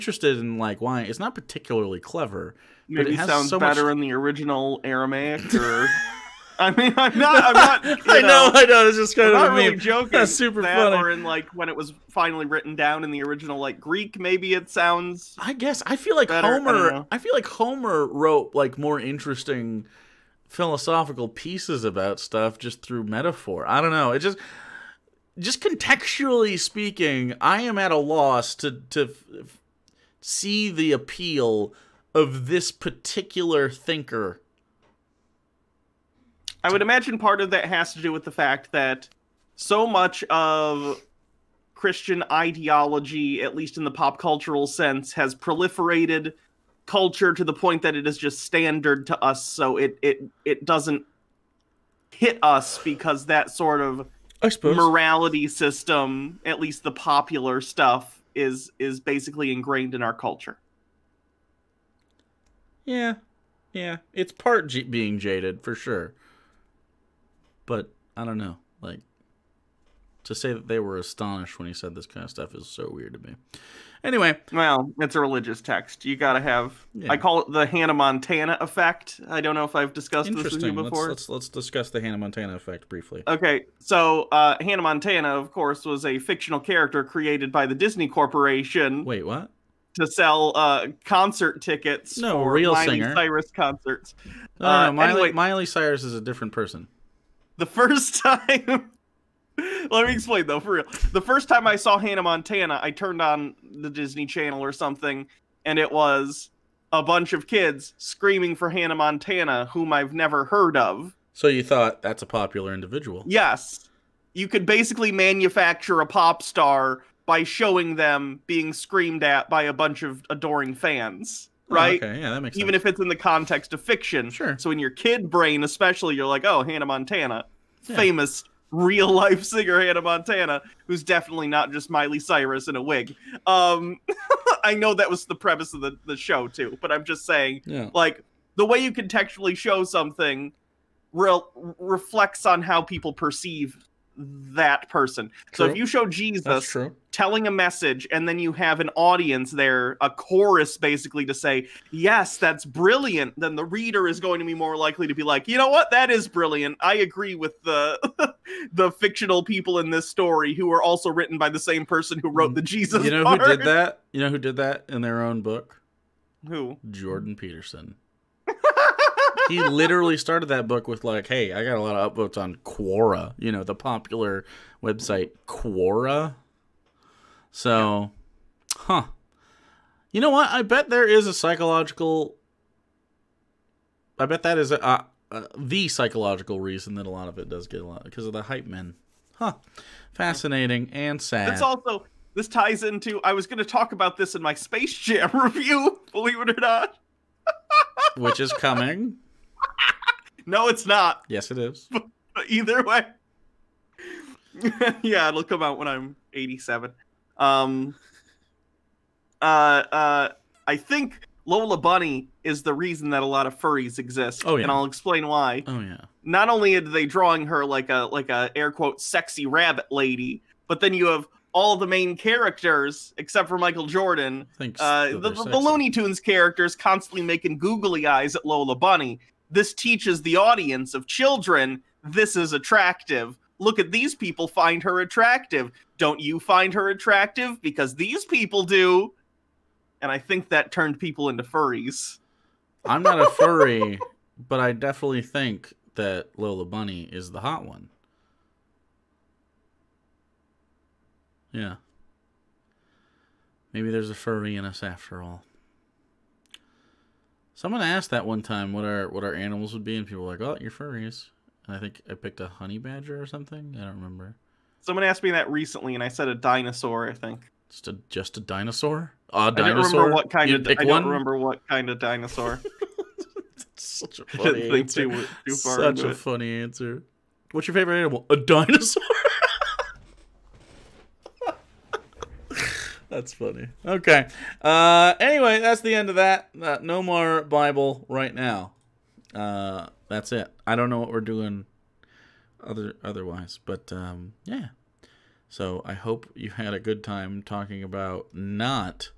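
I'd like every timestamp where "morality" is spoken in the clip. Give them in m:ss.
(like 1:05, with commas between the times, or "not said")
0:54.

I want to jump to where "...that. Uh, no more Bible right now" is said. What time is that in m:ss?
4:46.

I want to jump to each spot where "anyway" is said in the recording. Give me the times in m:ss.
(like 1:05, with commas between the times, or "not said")
1:14, 1:35, 4:45.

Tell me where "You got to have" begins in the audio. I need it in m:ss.
1:16.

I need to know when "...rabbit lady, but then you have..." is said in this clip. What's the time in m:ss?
3:39.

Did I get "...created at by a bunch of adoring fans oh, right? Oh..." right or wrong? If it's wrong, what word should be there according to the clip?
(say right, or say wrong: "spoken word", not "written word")
wrong: "screamed", not "created".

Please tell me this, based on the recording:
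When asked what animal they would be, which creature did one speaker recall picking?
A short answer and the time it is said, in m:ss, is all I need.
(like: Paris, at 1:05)
Honey badger, at 4:22.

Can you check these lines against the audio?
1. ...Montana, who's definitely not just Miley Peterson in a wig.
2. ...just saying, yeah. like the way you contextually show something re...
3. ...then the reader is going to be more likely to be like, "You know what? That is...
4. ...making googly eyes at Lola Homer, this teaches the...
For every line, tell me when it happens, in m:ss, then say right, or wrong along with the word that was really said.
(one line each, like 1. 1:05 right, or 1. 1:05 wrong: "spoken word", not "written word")
1. 2:10 wrong: "Cyrus", not "Peterson"
2. 2:17 right
3. 2:33 right
4. 3:47 wrong: "Bunny", not "Homer".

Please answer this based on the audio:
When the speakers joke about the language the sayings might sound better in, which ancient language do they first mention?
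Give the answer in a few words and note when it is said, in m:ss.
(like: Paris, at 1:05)
Aramaic, at 0:04.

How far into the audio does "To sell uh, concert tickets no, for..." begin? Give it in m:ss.
1:29.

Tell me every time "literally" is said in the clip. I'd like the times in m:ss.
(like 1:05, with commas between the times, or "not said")
2:49.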